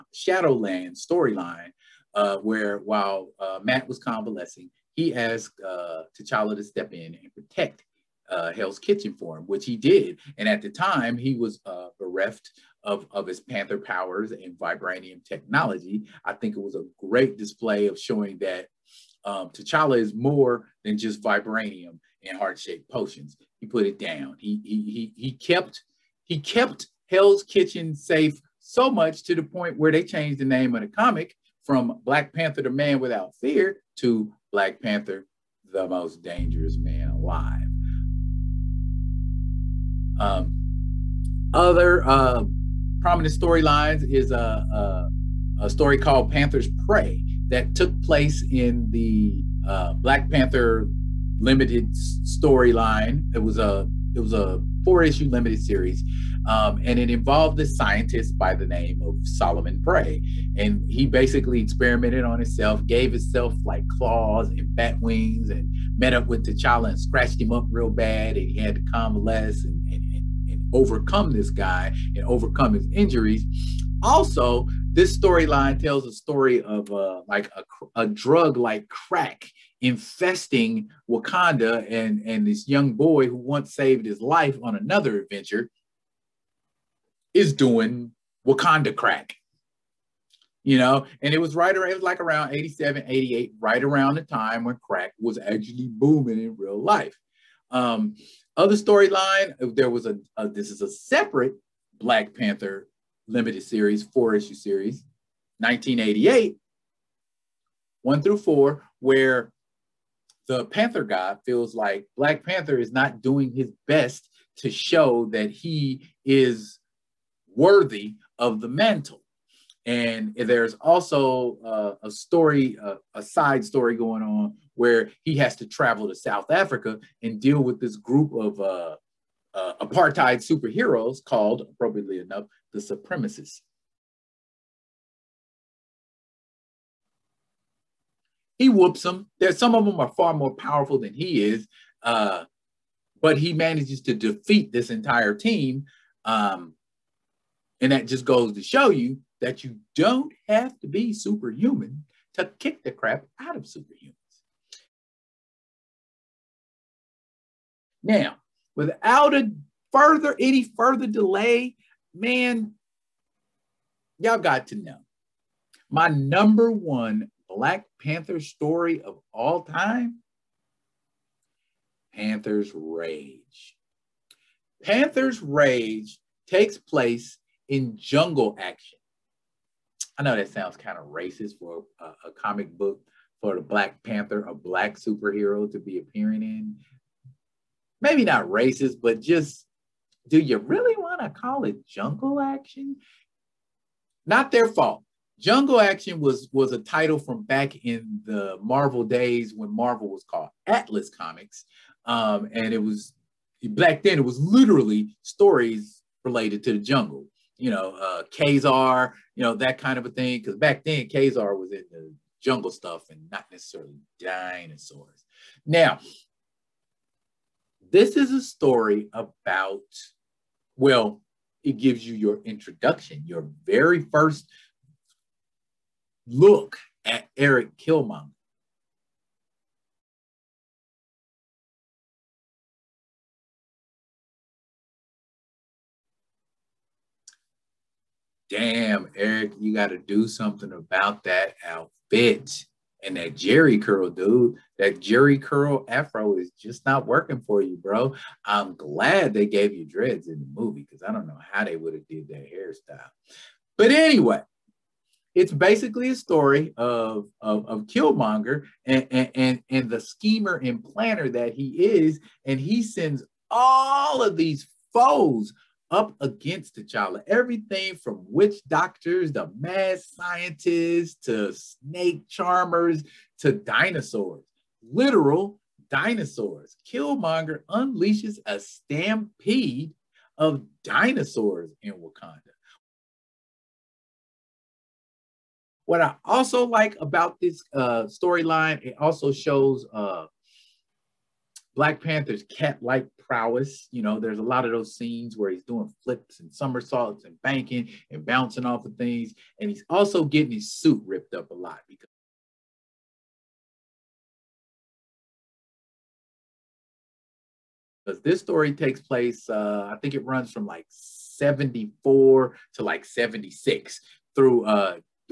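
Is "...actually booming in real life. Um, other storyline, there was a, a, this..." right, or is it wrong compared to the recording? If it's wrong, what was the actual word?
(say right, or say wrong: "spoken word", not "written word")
right.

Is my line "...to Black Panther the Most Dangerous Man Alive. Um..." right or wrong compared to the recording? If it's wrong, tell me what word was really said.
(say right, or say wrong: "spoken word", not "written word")
right.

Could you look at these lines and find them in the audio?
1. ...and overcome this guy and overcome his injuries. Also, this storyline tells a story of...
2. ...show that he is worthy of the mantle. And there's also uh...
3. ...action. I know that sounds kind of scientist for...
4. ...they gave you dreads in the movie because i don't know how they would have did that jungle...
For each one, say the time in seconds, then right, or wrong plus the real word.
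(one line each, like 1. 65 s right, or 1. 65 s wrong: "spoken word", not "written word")
1. 70 s right
2. 114 s right
3. 178 s wrong: "racist", not "scientist"
4. 249 s wrong: "hairstyle", not "jungle".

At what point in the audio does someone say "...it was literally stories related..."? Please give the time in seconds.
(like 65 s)
204 s.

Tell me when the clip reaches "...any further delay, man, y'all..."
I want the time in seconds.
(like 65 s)
160 s.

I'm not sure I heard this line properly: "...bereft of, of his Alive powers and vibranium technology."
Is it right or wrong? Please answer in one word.
wrong.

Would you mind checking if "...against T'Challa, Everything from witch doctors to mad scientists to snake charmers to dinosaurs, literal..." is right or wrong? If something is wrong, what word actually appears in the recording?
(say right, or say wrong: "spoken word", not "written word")
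right.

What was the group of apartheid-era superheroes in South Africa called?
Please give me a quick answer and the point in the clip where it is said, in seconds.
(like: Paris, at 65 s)
The Supremacists, at 132 s.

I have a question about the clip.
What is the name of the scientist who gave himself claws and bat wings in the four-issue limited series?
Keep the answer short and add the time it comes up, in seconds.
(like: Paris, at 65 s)
Solomon Prey, at 59 s.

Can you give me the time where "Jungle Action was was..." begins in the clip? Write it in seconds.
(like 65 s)
195 s.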